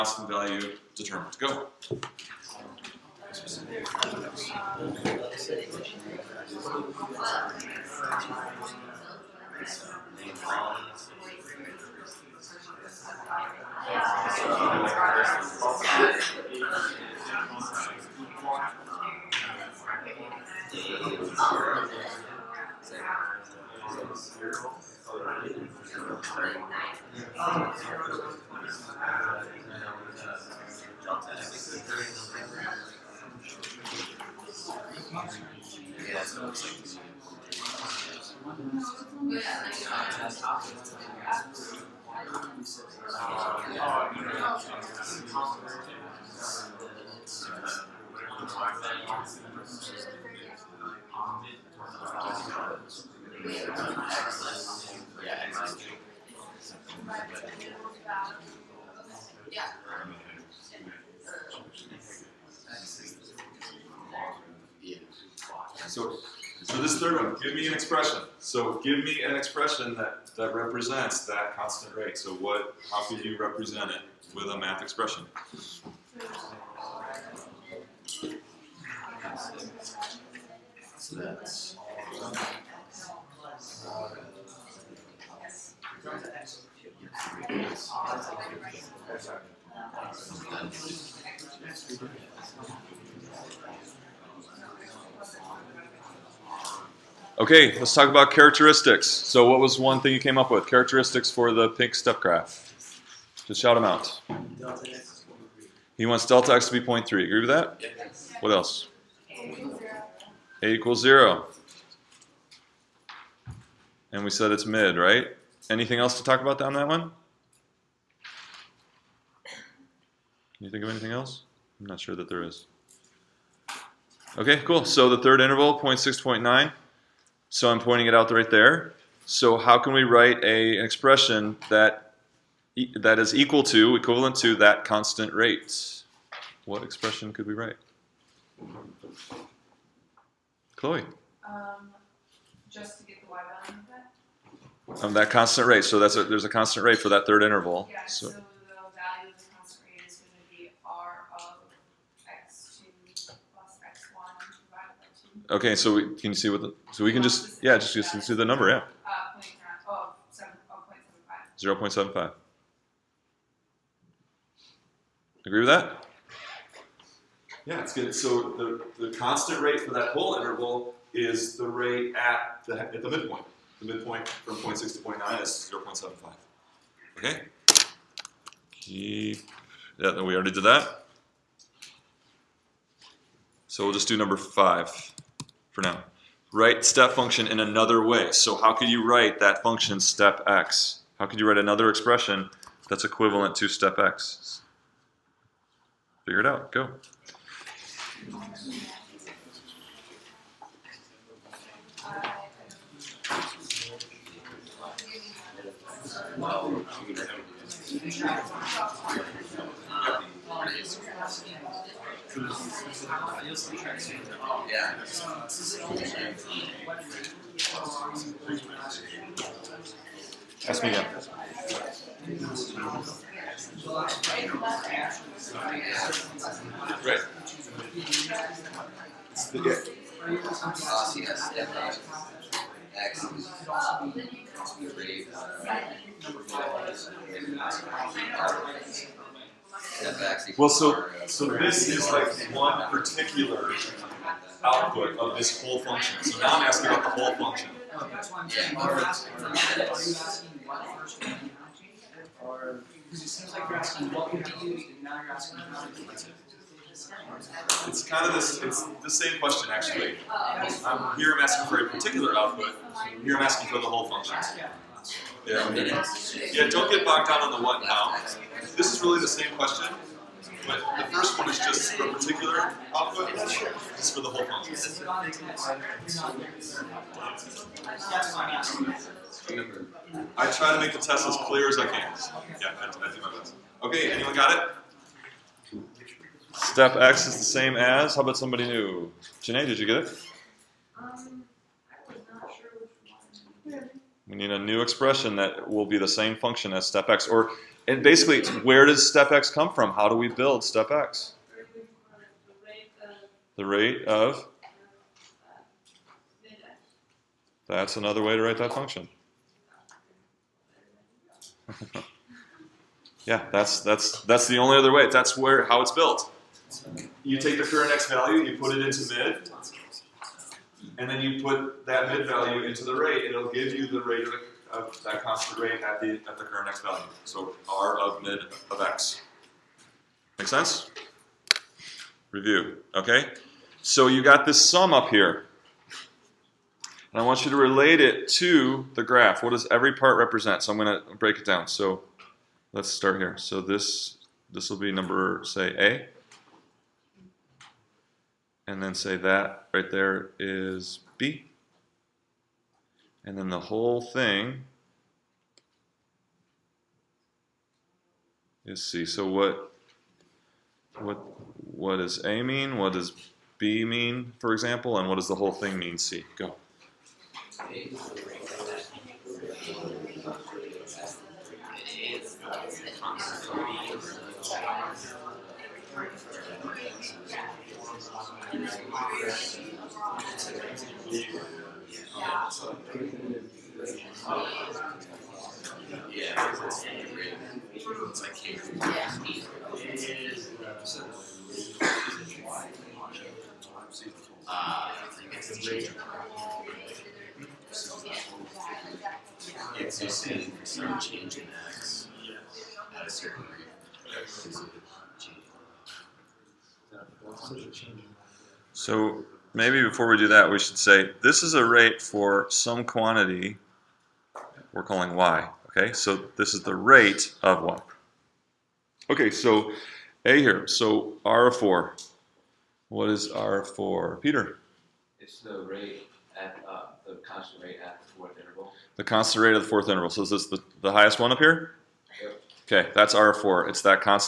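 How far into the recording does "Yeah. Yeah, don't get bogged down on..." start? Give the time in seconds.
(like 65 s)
265 s.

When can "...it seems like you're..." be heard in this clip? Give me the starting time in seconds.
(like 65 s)
253 s.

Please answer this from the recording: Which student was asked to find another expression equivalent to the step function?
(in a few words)
Janae.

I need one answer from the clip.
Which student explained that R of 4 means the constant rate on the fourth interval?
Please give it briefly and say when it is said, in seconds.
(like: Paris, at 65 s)
Peter, at 424 s.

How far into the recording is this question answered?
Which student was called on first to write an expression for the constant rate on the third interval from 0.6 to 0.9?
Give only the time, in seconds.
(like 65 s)
140 s.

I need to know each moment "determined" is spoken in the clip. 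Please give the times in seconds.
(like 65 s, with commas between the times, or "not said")
0 s.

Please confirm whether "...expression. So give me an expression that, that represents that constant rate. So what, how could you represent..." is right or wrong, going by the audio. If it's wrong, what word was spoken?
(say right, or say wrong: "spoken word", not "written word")
right.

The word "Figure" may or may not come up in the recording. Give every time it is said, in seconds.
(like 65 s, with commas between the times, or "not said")
196 s.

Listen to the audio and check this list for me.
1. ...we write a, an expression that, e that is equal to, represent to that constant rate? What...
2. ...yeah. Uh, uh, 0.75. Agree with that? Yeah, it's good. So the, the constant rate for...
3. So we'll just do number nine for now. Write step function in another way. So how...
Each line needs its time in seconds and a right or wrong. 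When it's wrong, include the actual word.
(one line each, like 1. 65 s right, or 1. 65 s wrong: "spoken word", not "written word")
1. 129 s wrong: "equivalent", not "represent"
2. 158 s right
3. 183 s wrong: "five", not "nine".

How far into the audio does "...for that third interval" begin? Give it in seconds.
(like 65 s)
146 s.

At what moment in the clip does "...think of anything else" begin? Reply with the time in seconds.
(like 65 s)
120 s.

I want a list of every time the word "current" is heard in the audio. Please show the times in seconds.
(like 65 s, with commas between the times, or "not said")
317 s, 326 s.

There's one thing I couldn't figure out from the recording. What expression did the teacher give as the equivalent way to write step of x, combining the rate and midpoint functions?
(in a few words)
r of mid of x.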